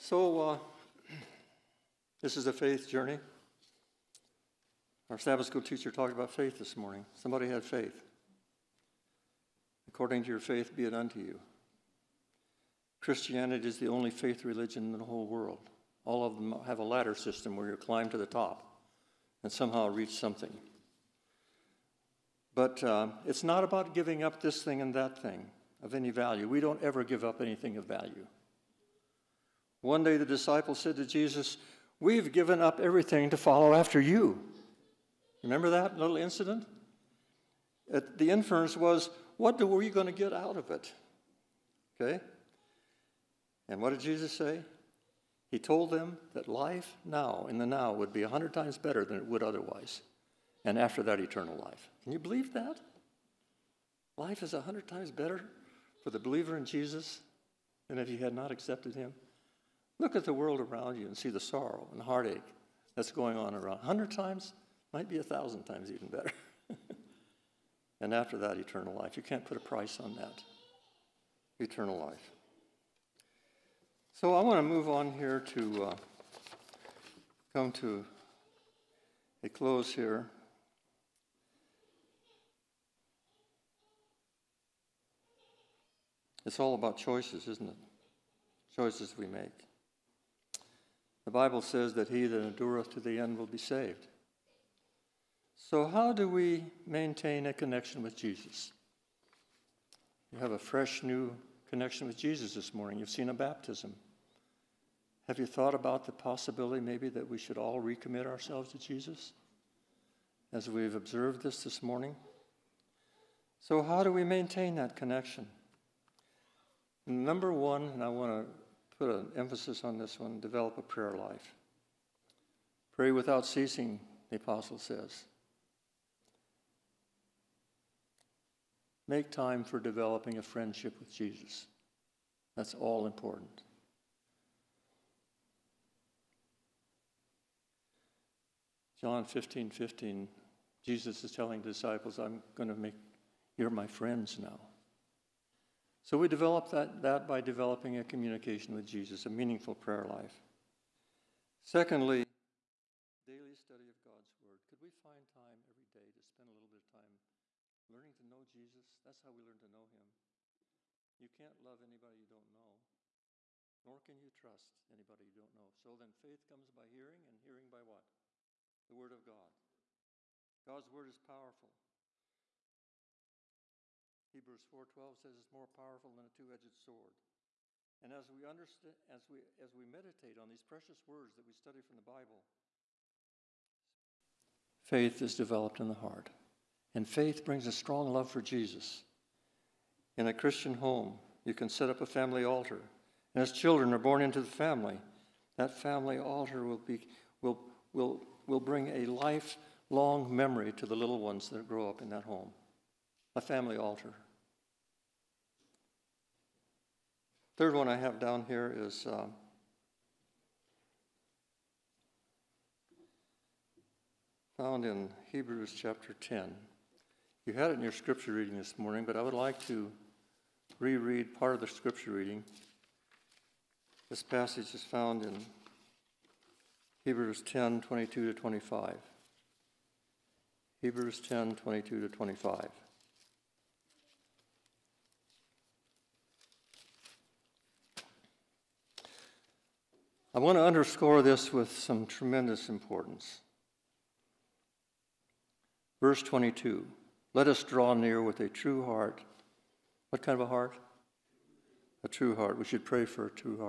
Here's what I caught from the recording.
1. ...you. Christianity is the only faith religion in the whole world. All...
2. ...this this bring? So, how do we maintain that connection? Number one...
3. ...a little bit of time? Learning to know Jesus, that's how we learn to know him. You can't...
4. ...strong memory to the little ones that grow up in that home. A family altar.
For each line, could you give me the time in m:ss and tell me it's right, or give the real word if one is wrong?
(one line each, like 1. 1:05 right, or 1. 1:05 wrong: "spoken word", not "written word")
1. 0:11 right
2. 1:51 wrong: "morning", not "bring"
3. 2:36 right
4. 3:19 wrong: "lifelong", not "strong".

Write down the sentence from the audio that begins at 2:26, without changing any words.
So we develop that, that by developing a communication with Jesus, a meaningful prayer life.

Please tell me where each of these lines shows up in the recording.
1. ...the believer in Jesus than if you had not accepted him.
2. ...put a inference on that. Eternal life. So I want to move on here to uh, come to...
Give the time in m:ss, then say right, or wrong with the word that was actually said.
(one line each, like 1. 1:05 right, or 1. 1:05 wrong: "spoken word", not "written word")
1. 0:56 right
2. 1:09 wrong: "price", not "inference".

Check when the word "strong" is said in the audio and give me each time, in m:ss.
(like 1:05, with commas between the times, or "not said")
3:07.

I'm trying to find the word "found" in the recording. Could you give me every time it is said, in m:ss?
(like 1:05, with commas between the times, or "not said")
3:34, 3:44.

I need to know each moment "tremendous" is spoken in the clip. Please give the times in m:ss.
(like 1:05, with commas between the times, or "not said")
4:02.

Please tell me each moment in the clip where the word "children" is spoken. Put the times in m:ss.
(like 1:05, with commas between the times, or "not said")
3:13.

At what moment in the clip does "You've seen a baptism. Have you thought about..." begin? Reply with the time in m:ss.
1:42.